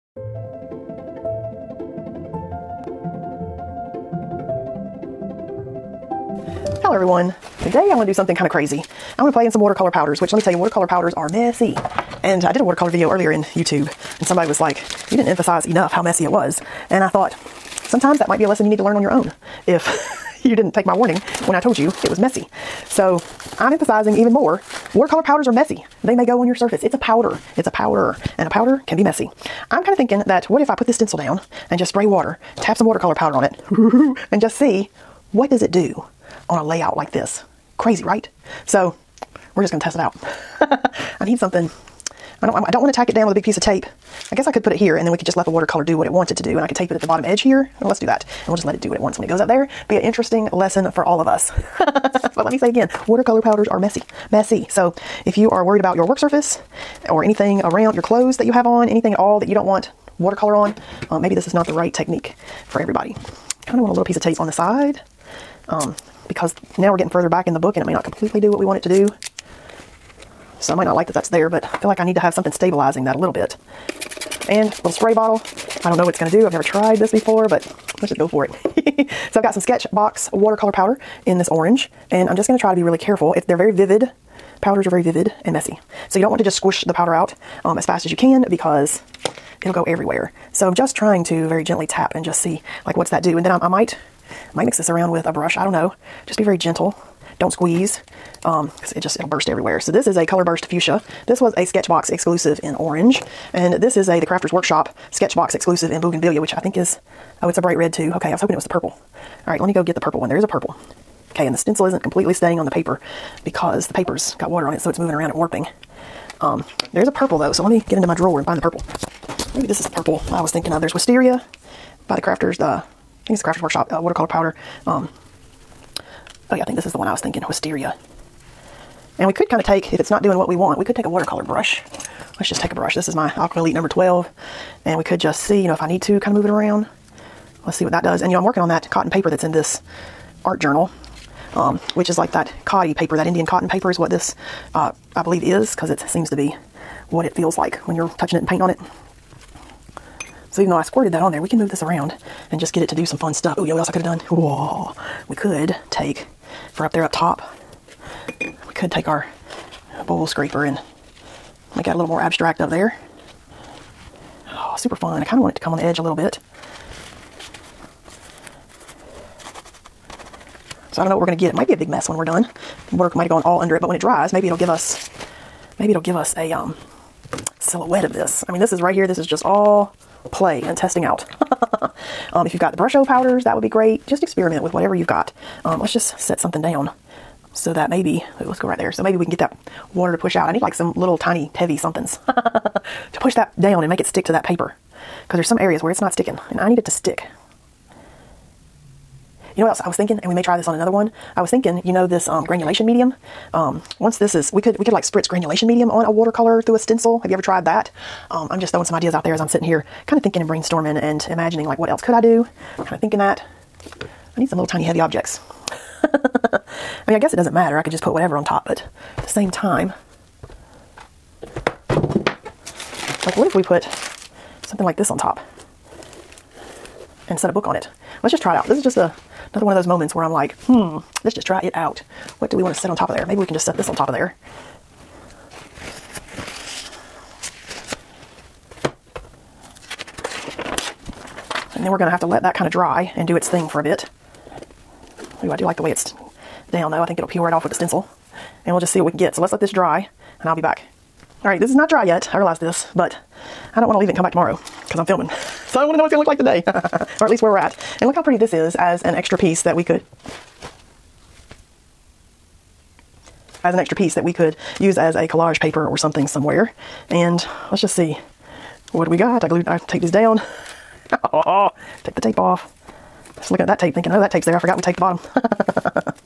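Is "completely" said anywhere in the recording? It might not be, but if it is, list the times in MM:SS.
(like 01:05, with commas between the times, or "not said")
01:08, 01:52.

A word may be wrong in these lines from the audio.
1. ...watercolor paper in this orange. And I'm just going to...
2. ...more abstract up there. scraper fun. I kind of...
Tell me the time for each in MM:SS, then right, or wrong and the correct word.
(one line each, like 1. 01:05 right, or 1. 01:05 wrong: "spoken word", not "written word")
1. 01:20 wrong: "powder", not "paper"
2. 02:42 wrong: "super", not "scraper".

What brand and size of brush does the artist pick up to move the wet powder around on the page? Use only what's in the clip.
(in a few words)
Aqua Elite number 12.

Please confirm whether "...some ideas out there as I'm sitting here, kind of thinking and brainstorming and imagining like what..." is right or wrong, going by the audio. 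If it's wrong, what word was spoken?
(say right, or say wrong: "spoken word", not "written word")
right.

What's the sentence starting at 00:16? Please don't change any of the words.
And I thought, sometimes that might be a lesson you need to learn on your own.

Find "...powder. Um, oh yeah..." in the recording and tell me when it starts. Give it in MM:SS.
02:04.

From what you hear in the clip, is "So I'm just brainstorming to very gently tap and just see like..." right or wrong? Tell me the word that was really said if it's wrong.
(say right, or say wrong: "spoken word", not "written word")
wrong: "trying", not "brainstorming".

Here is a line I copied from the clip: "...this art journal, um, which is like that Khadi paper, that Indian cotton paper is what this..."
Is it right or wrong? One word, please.
right.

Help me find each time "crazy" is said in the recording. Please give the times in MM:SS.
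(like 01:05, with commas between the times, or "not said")
00:08, 00:37.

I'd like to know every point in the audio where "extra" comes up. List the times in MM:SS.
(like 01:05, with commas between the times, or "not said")
04:19, 04:23.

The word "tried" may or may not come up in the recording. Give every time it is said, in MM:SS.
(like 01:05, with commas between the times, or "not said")
01:16, 03:27.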